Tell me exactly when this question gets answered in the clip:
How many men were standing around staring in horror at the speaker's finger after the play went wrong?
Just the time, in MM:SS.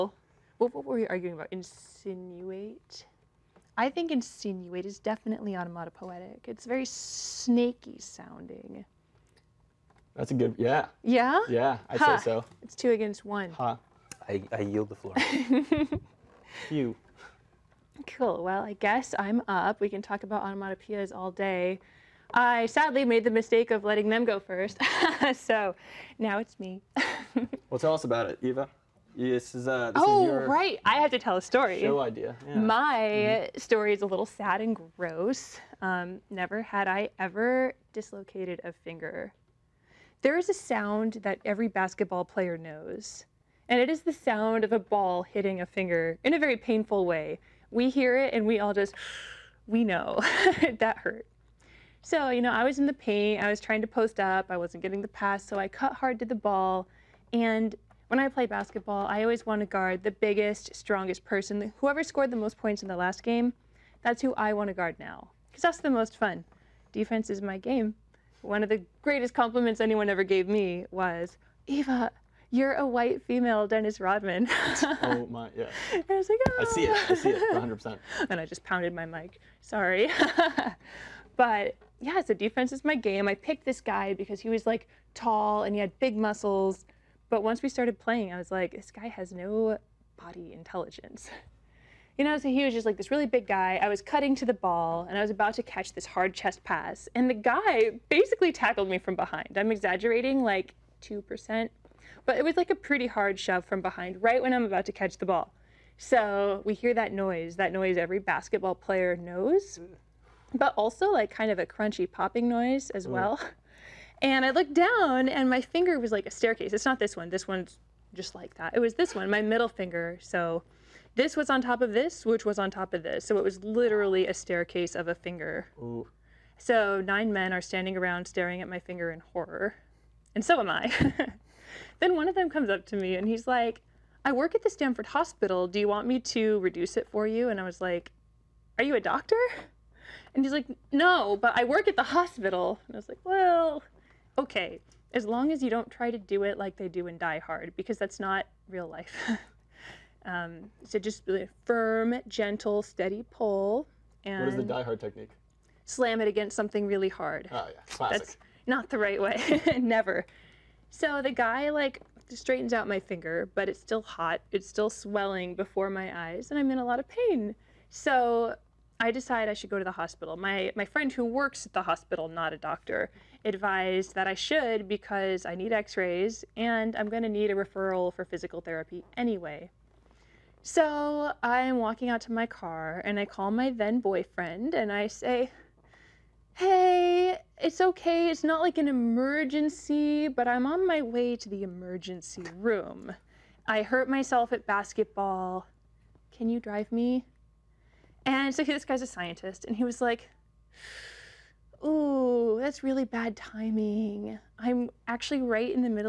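02:07.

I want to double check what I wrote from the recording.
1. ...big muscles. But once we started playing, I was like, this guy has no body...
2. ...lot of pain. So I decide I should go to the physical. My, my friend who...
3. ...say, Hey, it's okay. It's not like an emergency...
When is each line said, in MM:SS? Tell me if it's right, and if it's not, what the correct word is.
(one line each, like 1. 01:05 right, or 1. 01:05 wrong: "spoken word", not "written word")
1. 01:25 right
2. 02:46 wrong: "hospital", not "physical"
3. 03:05 right.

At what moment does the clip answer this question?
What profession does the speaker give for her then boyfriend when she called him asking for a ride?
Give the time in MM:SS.
03:19.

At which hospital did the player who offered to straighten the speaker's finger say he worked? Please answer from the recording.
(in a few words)
Stanford Hospital.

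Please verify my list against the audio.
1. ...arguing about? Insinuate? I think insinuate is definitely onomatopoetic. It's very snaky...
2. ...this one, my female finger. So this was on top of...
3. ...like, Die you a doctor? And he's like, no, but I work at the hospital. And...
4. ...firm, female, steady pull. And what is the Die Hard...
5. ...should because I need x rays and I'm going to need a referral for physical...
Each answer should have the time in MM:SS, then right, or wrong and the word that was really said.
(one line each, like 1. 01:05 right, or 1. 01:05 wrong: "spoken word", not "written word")
1. 00:01 right
2. 01:58 wrong: "middle", not "female"
3. 02:17 wrong: "Are", not "Die"
4. 02:31 wrong: "gentle", not "female"
5. 02:54 right.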